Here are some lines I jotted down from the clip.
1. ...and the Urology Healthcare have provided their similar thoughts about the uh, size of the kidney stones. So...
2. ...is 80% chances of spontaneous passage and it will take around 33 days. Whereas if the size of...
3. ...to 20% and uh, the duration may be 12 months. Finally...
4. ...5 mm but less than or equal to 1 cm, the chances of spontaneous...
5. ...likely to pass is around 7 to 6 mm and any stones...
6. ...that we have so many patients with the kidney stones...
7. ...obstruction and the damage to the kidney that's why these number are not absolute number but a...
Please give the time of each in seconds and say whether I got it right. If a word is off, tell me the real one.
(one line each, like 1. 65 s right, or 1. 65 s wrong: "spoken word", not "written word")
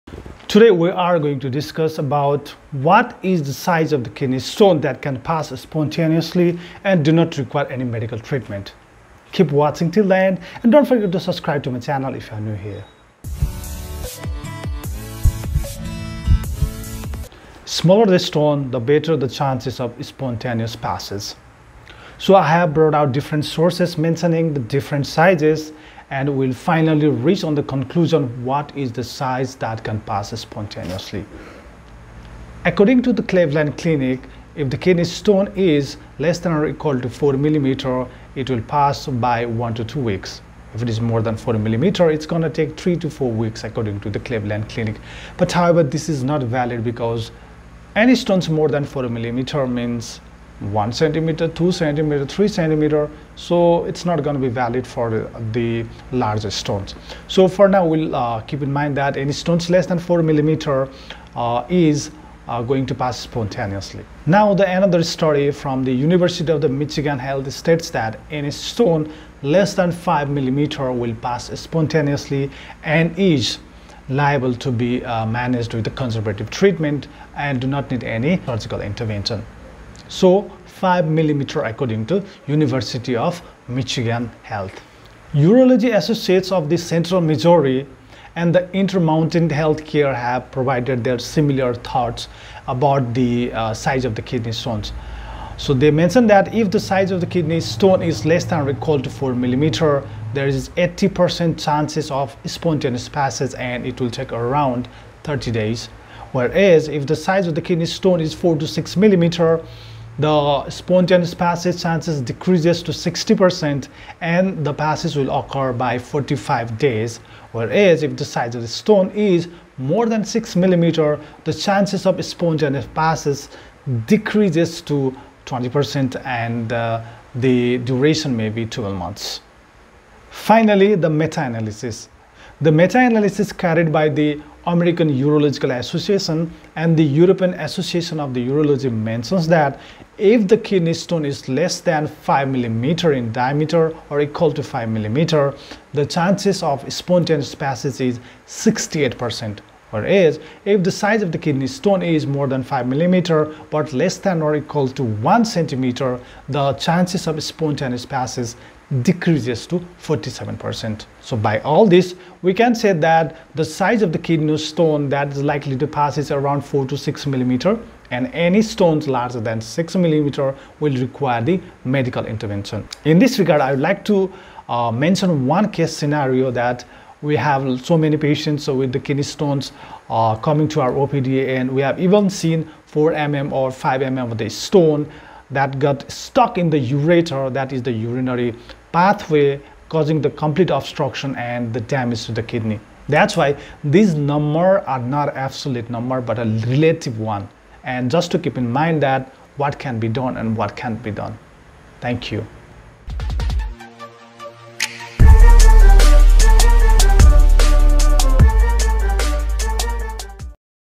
1. 88 s wrong: "Intermountain", not "Urology"
2. 100 s wrong: "30", not "33"
3. 124 s right
4. 152 s right
5. 165 s wrong: "4", not "7"
6. 176 s right
7. 190 s right.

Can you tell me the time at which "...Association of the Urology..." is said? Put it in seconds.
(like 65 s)
137 s.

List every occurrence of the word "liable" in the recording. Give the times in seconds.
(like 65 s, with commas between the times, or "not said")
74 s.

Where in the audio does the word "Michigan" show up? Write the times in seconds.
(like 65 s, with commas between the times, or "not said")
66 s, 83 s.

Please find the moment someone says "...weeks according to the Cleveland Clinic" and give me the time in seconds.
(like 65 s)
43 s.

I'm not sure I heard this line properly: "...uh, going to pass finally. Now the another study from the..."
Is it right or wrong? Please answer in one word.
wrong.